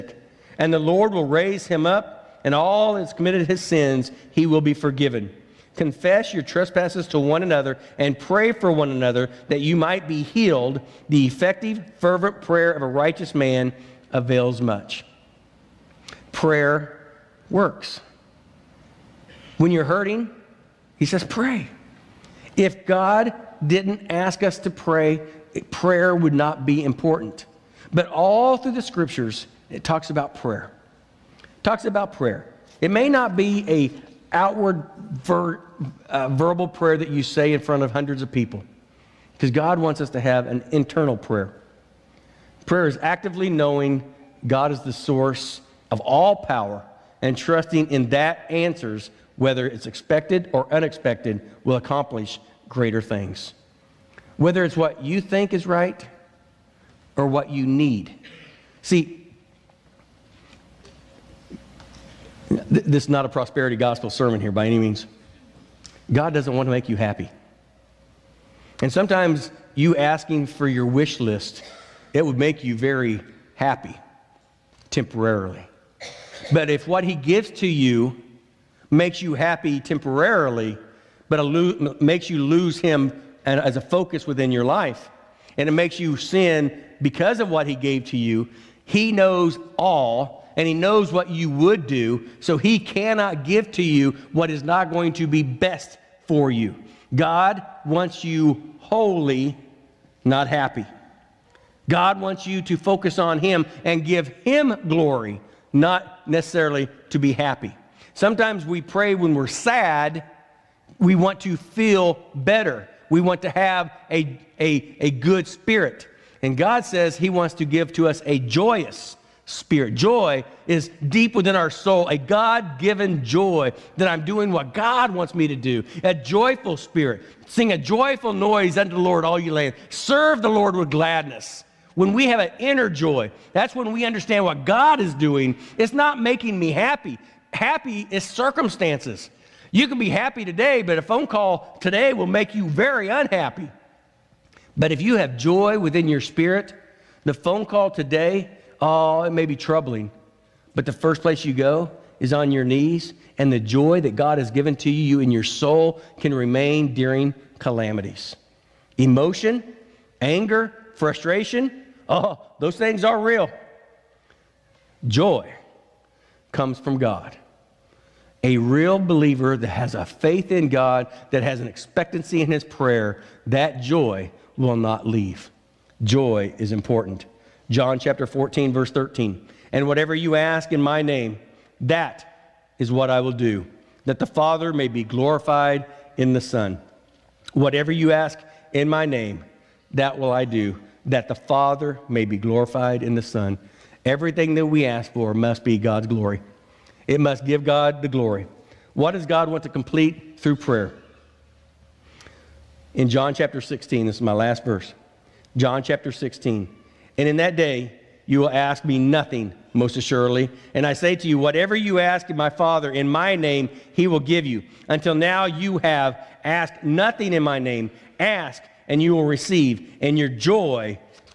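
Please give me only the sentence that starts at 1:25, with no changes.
And it makes you sin because of what He gave to you.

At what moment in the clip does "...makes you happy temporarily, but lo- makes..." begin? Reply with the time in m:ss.
1:18.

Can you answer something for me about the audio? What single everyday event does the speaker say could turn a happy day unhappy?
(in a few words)
a phone call.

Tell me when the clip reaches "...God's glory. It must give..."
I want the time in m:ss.
3:15.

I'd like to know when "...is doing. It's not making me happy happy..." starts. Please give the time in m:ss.
2:14.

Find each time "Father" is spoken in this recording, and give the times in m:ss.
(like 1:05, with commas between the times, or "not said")
3:04, 3:11, 3:32.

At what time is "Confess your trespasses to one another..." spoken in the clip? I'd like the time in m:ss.
0:05.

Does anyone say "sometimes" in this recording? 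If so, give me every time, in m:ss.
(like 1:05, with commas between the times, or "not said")
1:08, 1:48.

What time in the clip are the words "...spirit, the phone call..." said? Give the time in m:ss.
2:26.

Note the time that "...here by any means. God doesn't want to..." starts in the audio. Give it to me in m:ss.
1:04.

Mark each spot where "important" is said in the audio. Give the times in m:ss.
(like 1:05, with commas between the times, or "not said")
0:26, 2:56.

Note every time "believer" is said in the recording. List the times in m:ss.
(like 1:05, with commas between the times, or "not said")
2:48.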